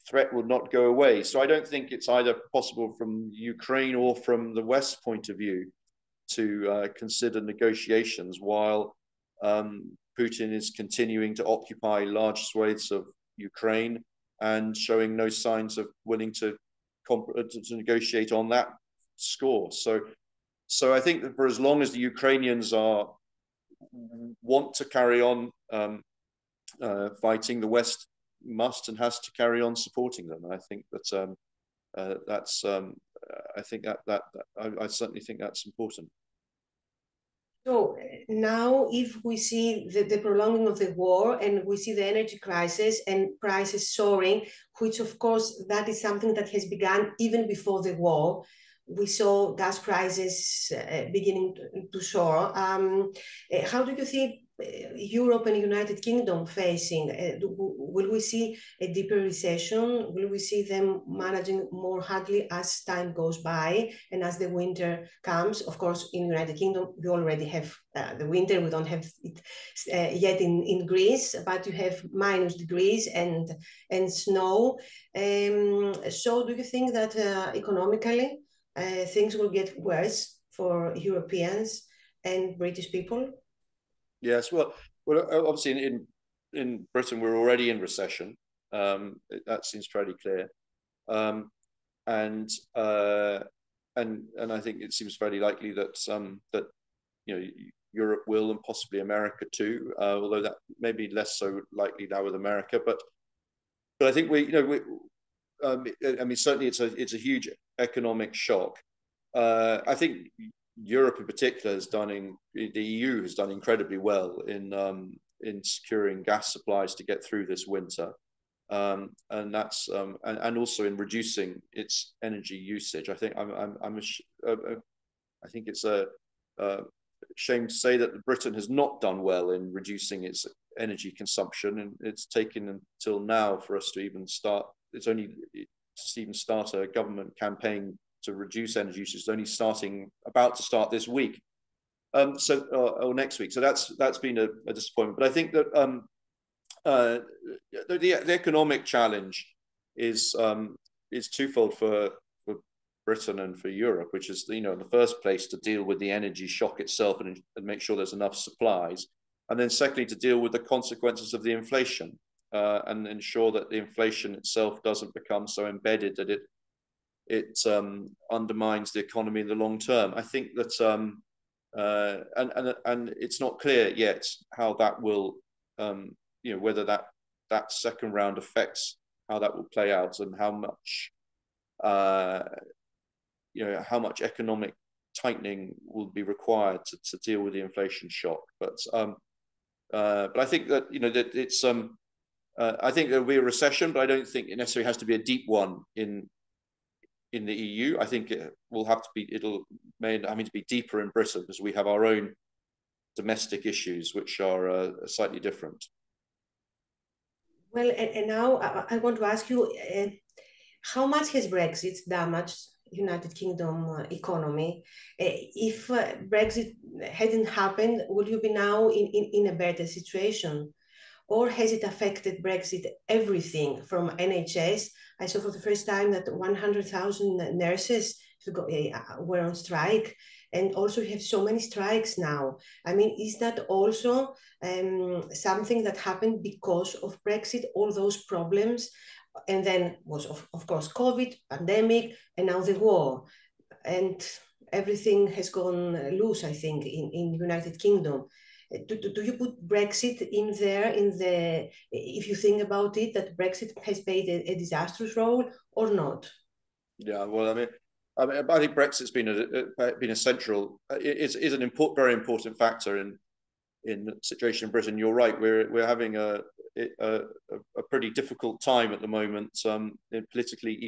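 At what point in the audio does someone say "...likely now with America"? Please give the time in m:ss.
1:41.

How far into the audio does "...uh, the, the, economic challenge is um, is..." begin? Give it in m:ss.
2:26.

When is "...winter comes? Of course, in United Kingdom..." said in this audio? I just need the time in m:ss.
1:04.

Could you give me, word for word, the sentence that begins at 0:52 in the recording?
Um, eh, how do you think uh, Europe and United Kingdom facing?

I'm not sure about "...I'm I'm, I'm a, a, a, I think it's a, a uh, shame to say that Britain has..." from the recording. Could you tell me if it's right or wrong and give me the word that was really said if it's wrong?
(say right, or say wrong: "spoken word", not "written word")
right.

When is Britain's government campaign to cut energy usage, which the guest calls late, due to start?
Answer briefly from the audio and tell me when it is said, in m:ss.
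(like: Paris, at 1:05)
this week, at 2:20.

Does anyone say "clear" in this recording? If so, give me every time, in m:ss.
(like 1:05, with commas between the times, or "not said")
1:30, 2:53.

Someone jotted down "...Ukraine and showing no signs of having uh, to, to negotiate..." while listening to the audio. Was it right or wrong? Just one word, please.
wrong.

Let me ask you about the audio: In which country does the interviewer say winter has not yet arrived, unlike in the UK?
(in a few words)
Greece.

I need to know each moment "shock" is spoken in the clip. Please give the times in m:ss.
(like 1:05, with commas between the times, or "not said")
1:48, 2:36, 3:08.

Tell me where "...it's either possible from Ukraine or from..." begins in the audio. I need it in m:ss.
0:01.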